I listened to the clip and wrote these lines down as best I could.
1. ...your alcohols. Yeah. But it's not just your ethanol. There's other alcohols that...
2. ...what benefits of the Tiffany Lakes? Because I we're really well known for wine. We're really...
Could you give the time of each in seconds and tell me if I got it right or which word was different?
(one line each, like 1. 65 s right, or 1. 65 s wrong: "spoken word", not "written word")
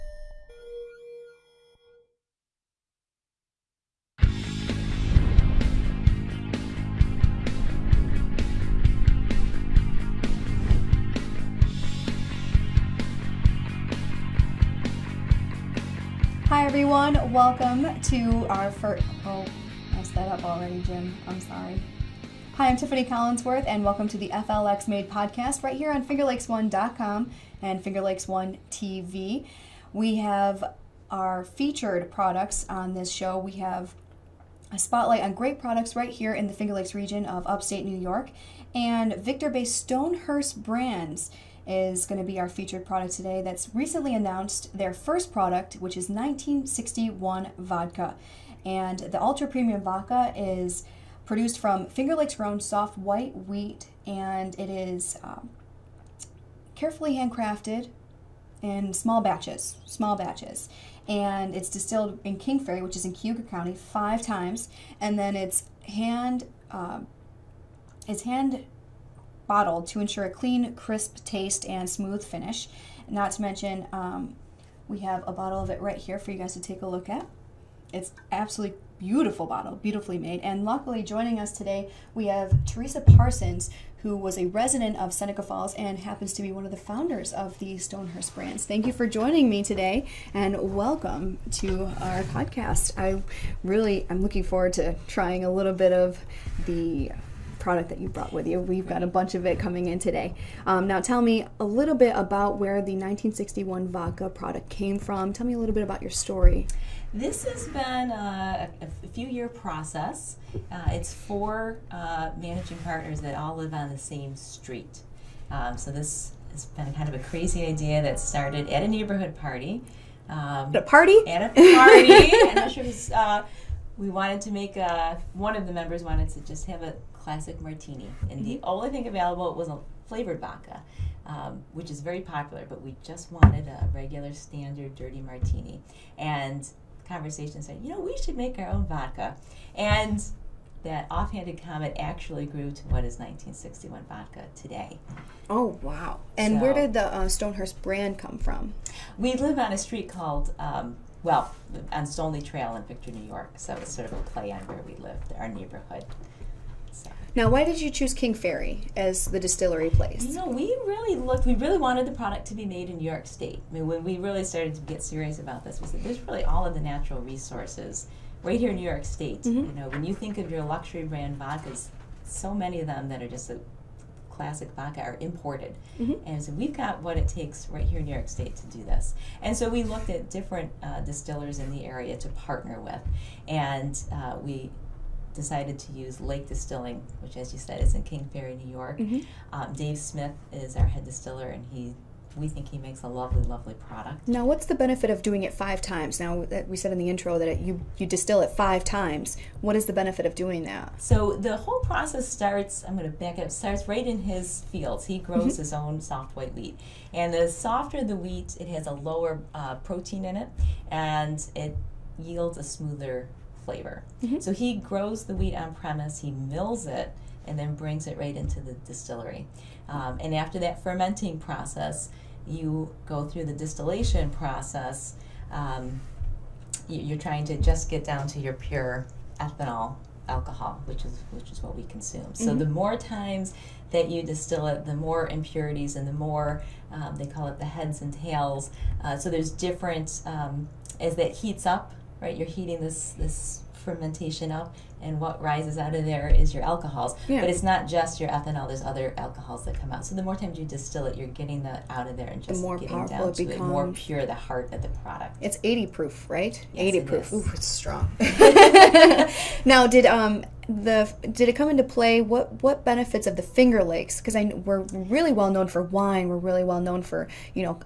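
1. 246 s right
2. 262 s wrong: "Finger", not "Tiffany".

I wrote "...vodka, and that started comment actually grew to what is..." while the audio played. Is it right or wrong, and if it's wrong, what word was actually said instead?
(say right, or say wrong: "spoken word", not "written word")
wrong: "offhanded", not "started".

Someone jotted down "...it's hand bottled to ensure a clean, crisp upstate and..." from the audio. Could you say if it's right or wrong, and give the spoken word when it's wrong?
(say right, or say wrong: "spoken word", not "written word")
wrong: "taste", not "upstate".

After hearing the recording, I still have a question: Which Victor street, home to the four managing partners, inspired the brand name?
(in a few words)
Stoney Trail.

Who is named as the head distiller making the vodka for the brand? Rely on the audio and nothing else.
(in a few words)
Dave Smith.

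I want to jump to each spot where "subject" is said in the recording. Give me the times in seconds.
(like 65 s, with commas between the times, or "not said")
not said.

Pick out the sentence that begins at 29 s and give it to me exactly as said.
We have our featured products on this show.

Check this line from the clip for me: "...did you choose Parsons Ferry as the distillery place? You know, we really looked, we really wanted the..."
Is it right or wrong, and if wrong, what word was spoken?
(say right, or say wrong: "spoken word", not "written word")
wrong: "King", not "Parsons".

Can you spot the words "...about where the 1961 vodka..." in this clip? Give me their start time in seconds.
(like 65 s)
102 s.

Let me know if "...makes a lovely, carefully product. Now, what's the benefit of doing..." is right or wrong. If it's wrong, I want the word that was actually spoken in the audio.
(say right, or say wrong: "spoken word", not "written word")
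wrong: "lovely", not "carefully".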